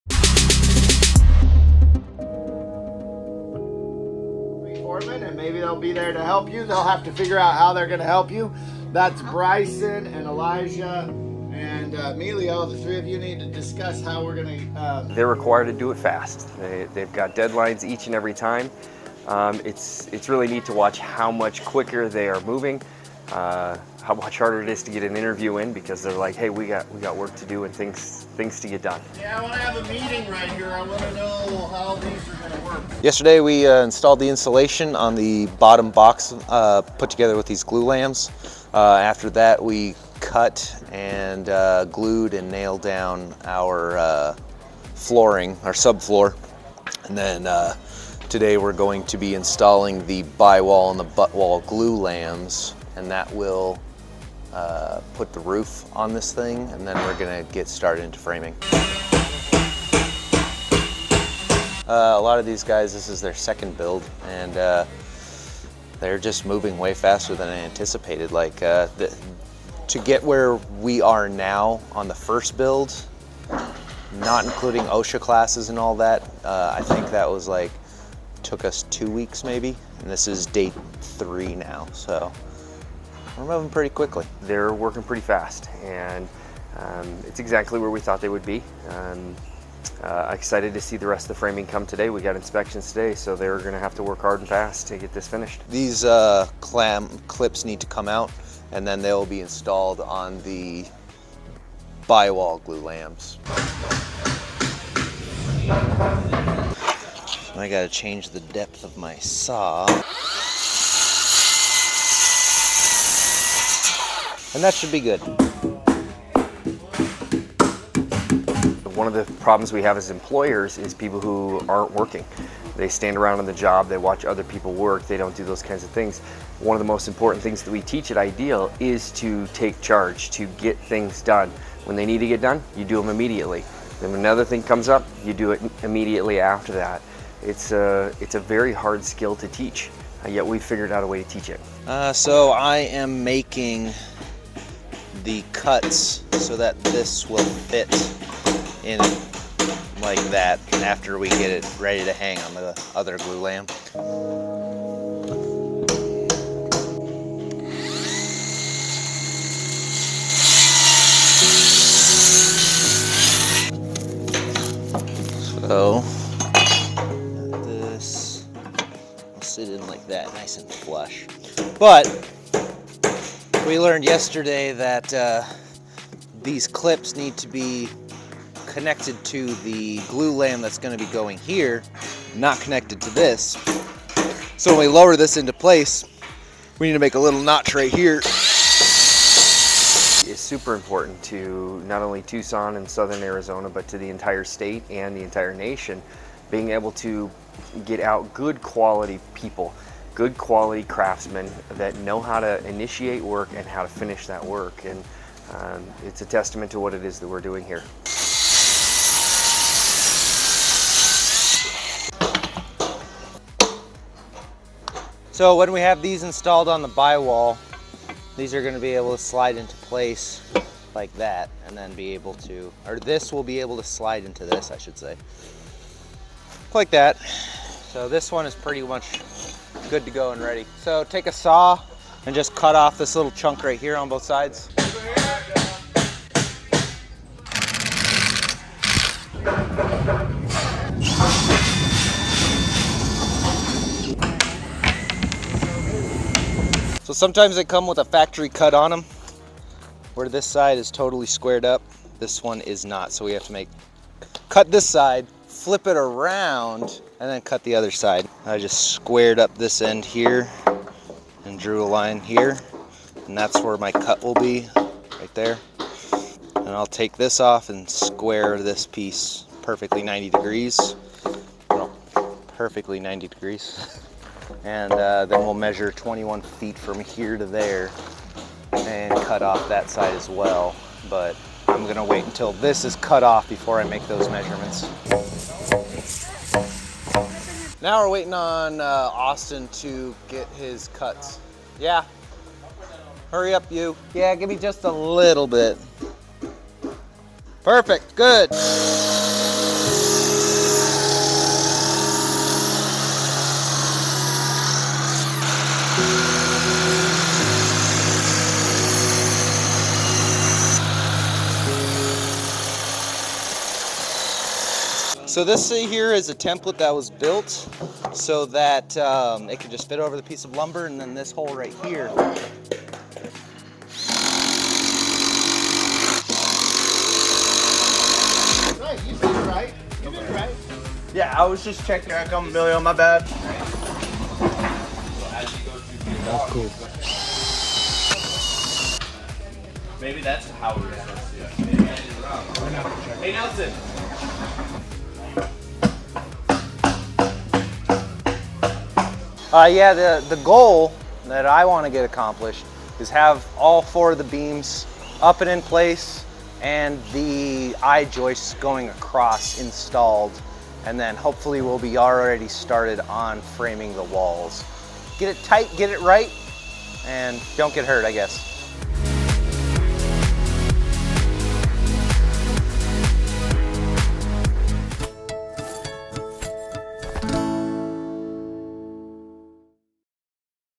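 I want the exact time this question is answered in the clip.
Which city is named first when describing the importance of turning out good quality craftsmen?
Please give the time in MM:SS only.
03:12.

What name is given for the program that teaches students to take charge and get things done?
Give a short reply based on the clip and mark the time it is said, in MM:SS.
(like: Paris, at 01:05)
Idea'l, at 02:08.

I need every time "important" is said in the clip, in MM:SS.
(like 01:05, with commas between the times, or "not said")
02:07, 03:10.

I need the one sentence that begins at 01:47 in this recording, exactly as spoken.
I got to change the depth of my saw.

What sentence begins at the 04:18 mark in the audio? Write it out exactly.
I just squared up this end here and drew a line here and that's where my cut will be right there.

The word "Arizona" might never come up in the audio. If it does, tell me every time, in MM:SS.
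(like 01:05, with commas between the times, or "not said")
03:13.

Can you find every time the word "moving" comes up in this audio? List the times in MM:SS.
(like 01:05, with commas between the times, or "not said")
00:22, 01:06, 01:23.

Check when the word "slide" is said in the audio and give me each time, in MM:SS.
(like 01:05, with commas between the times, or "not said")
03:39, 03:43.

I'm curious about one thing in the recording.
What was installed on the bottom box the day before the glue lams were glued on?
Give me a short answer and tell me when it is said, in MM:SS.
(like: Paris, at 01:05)
insulation, at 00:34.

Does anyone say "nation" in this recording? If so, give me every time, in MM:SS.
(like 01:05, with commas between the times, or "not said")
03:15.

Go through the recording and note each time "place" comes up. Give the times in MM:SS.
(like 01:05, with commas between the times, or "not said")
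03:05, 03:39, 05:55.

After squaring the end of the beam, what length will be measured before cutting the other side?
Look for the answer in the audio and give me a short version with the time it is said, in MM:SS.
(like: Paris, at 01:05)
21 feet, at 04:35.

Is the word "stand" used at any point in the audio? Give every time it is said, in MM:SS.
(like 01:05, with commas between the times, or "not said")
02:02.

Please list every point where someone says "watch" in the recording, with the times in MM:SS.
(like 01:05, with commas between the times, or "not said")
00:20, 02:03.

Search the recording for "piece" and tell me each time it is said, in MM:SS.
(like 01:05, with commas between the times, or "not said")
04:28, 05:20.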